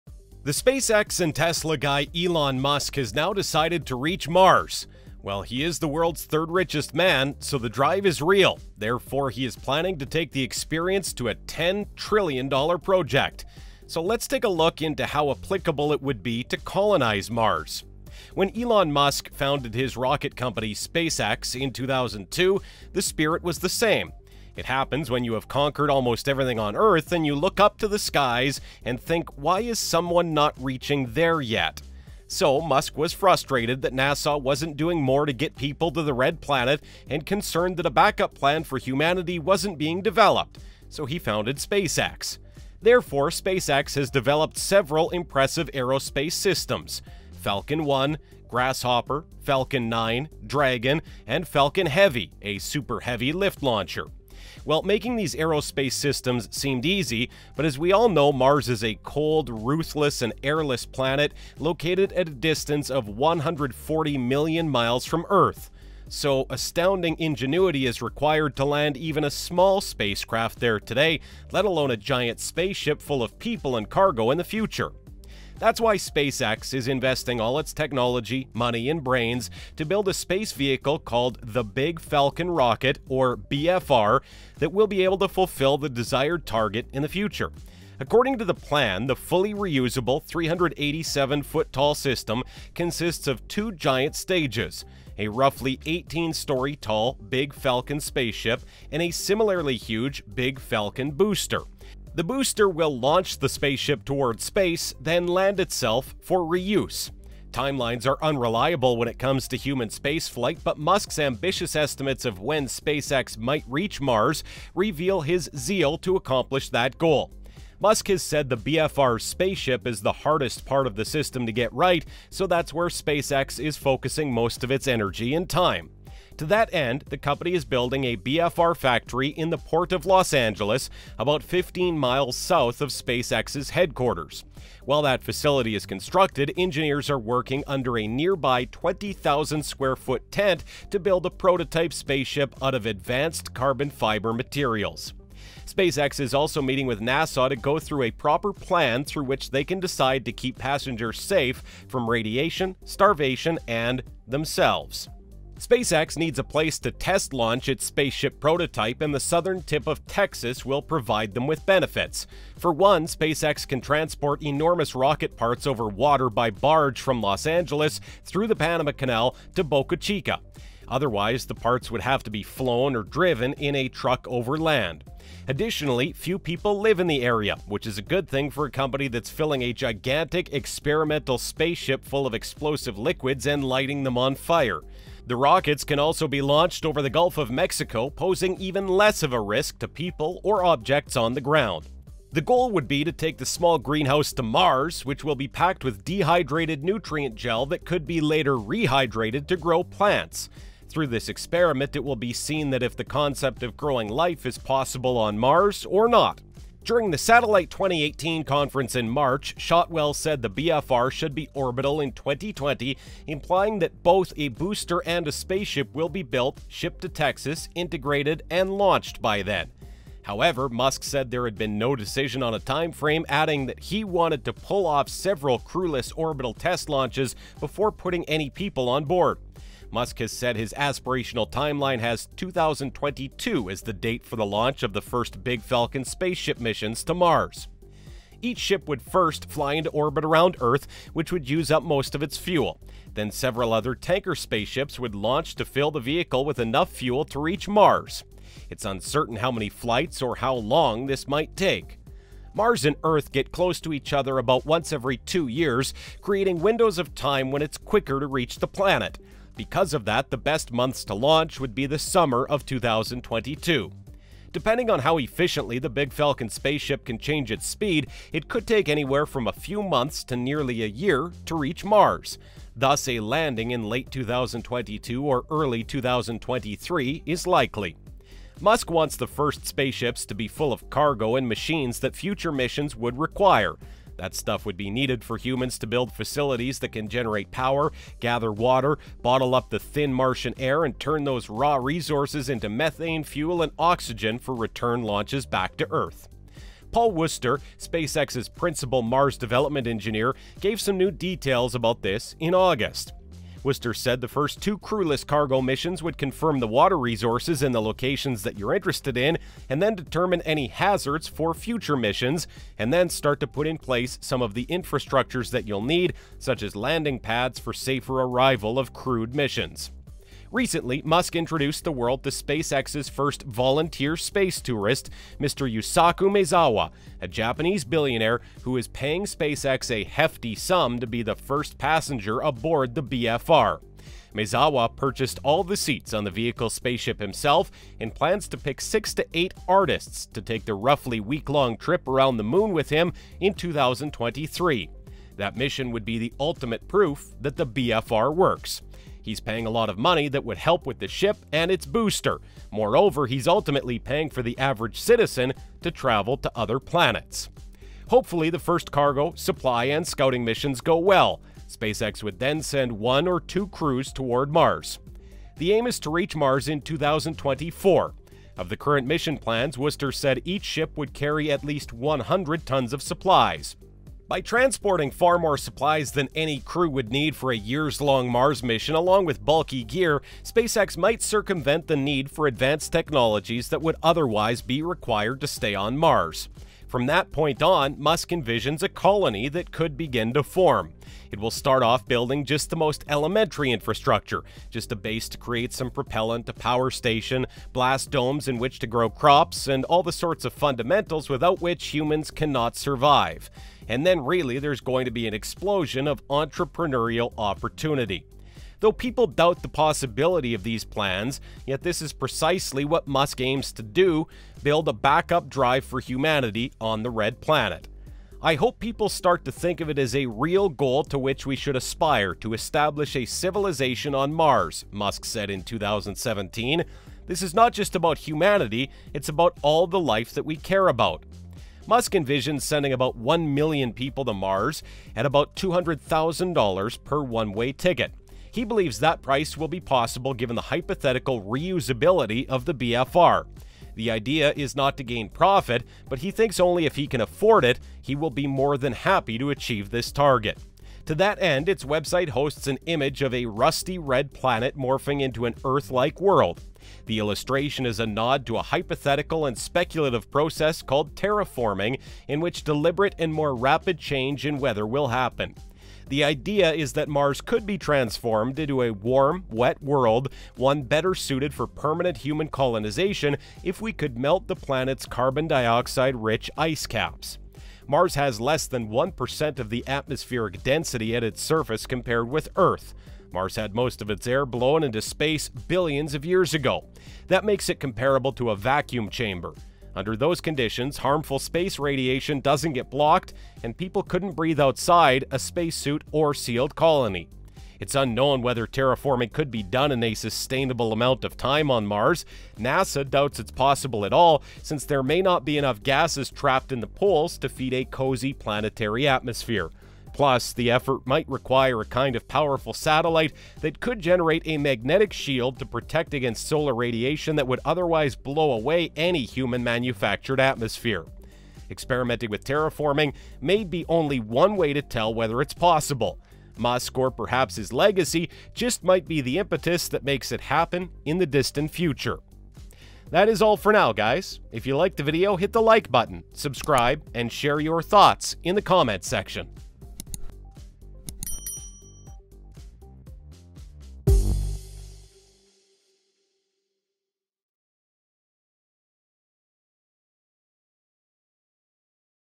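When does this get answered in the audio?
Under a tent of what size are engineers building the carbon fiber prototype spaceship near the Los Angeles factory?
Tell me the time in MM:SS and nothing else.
02:18.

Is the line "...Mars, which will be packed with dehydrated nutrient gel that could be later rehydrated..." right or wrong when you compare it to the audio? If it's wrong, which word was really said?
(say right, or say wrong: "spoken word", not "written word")
right.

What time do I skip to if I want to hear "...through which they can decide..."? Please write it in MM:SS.
02:29.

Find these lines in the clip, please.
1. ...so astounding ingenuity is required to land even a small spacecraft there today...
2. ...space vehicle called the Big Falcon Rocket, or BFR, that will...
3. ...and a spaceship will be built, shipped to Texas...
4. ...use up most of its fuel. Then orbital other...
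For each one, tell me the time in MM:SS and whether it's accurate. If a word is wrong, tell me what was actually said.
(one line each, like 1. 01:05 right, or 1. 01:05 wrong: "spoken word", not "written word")
1. 01:06 right
2. 01:20 right
3. 03:35 right
4. 04:01 wrong: "several", not "orbital".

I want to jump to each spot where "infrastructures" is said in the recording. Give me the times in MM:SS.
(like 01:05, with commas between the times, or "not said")
05:14, 06:33.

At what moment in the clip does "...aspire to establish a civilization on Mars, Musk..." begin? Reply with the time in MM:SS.
07:01.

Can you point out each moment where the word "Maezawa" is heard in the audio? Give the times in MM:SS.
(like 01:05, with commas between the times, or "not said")
05:26, 05:34.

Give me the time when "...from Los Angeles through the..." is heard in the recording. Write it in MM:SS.
02:46.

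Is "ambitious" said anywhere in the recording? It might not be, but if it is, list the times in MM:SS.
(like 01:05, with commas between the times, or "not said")
01:51.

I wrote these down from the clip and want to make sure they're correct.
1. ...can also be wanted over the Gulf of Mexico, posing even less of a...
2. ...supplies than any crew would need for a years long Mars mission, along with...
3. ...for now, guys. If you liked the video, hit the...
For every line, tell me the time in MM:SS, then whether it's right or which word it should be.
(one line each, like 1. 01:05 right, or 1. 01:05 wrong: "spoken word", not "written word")
1. 03:05 wrong: "launched", not "wanted"
2. 06:15 right
3. 08:53 right.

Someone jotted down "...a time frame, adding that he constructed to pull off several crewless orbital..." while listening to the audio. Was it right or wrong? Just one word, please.
wrong.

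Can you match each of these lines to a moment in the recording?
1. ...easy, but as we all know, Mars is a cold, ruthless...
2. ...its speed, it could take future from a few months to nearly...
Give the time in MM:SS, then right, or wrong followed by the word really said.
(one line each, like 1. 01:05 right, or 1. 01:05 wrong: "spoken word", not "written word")
1. 00:56 right
2. 04:27 wrong: "anywhere", not "future".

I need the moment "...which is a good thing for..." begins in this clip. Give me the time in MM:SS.
02:57.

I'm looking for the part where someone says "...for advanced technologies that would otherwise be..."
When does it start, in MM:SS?
06:22.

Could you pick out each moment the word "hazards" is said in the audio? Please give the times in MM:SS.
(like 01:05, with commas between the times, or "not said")
05:10.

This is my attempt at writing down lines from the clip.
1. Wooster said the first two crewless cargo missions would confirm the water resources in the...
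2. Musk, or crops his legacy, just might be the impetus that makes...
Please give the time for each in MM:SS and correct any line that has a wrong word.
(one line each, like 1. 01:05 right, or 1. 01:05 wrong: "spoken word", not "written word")
1. 05:03 right
2. 08:46 wrong: "perhaps", not "crops".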